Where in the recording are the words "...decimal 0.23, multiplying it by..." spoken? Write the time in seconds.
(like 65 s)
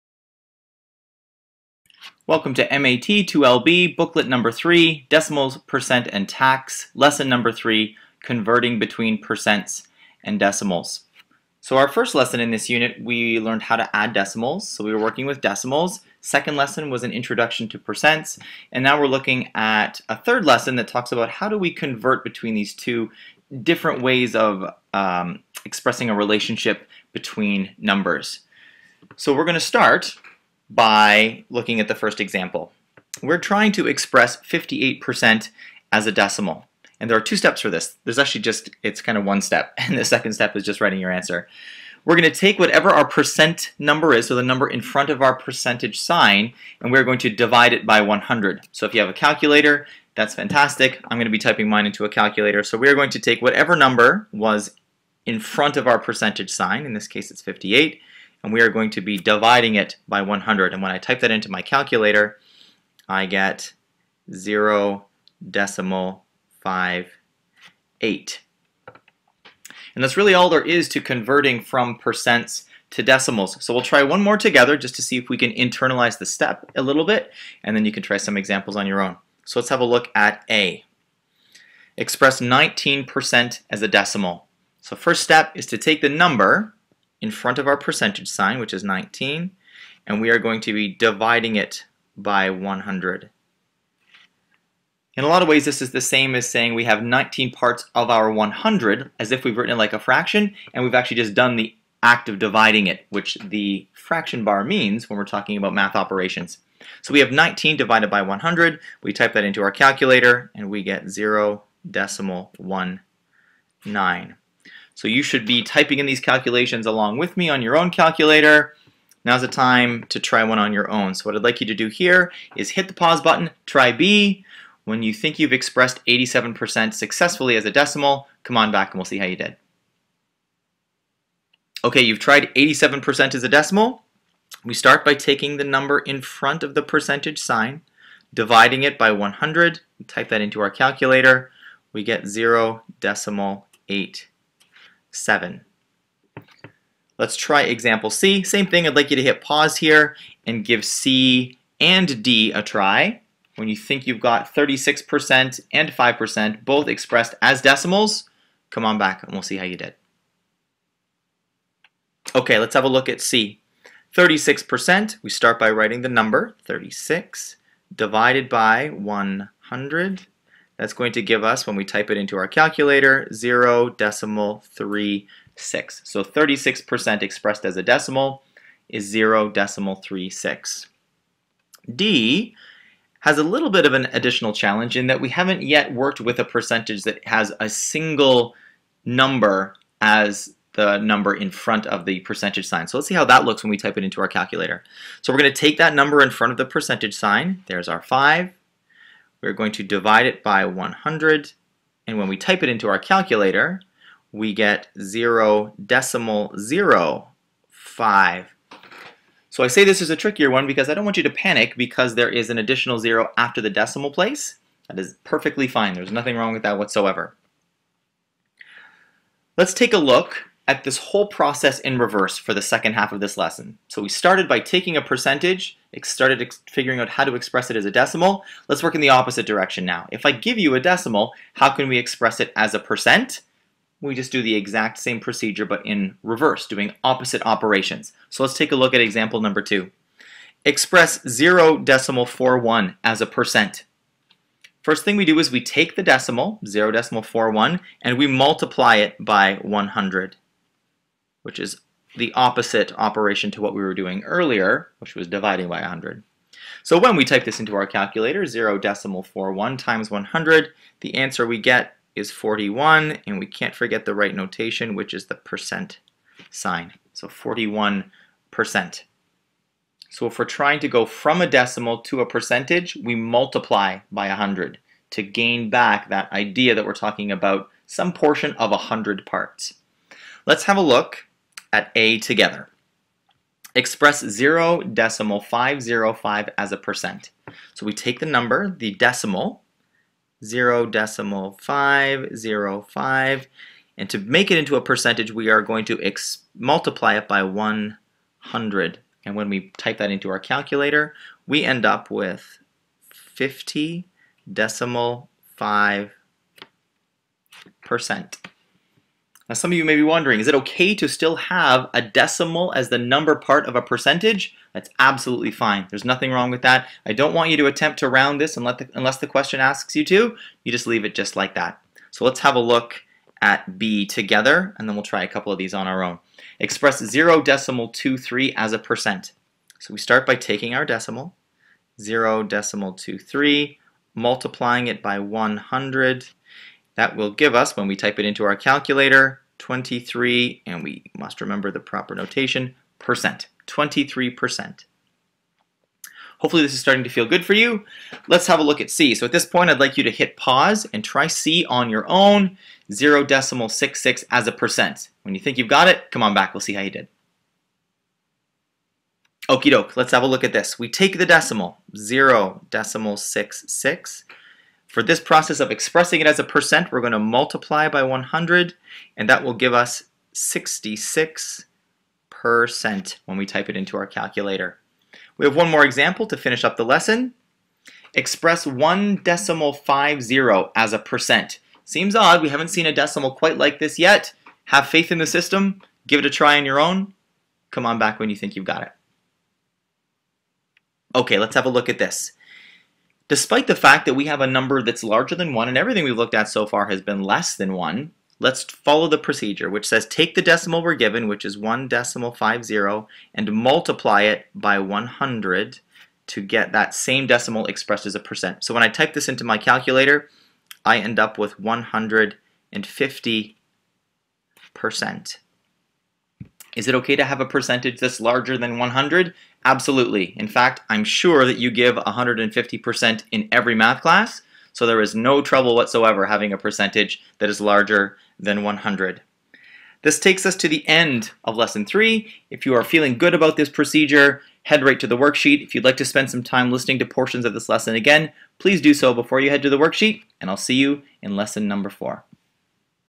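332 s.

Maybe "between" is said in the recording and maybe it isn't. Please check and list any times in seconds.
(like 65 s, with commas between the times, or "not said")
8 s, 22 s, 27 s.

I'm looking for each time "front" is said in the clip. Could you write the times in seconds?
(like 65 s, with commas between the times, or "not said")
44 s, 55 s, 87 s, 136 s, 191 s, 196 s.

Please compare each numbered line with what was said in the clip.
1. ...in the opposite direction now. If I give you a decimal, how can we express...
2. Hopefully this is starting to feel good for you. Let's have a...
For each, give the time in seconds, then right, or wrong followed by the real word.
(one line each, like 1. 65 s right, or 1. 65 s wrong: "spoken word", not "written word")
1. 228 s right
2. 346 s right.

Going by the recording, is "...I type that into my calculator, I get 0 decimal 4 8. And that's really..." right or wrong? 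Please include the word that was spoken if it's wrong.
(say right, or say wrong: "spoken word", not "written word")
wrong: "5", not "4".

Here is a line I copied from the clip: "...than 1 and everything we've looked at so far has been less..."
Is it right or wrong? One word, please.
right.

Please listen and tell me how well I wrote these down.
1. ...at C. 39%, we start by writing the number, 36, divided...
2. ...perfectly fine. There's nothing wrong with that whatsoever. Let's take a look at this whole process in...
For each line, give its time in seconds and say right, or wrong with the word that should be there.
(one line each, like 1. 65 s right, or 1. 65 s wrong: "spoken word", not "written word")
1. 163 s wrong: "36", not "39"
2. 215 s right.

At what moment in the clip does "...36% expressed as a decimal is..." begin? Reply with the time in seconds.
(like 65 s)
176 s.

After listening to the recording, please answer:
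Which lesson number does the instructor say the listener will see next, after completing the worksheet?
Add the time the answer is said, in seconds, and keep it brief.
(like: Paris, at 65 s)
Lesson 4, at 441 s.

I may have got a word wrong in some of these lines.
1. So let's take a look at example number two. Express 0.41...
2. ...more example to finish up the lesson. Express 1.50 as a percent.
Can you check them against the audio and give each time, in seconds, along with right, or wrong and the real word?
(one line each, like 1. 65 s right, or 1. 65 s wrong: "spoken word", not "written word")
1. 238 s right
2. 375 s right.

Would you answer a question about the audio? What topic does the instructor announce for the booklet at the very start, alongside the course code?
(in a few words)
Decimals, Percent, and Tax.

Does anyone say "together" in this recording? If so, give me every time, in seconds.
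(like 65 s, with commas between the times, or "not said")
74 s, 282 s, 324 s.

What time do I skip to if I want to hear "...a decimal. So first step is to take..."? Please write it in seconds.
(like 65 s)
83 s.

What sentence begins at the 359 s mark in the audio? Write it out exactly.
Okie doke, let's have a look at this.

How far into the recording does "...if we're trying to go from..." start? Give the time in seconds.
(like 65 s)
270 s.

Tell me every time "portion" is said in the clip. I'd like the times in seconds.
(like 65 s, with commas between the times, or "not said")
278 s, 437 s.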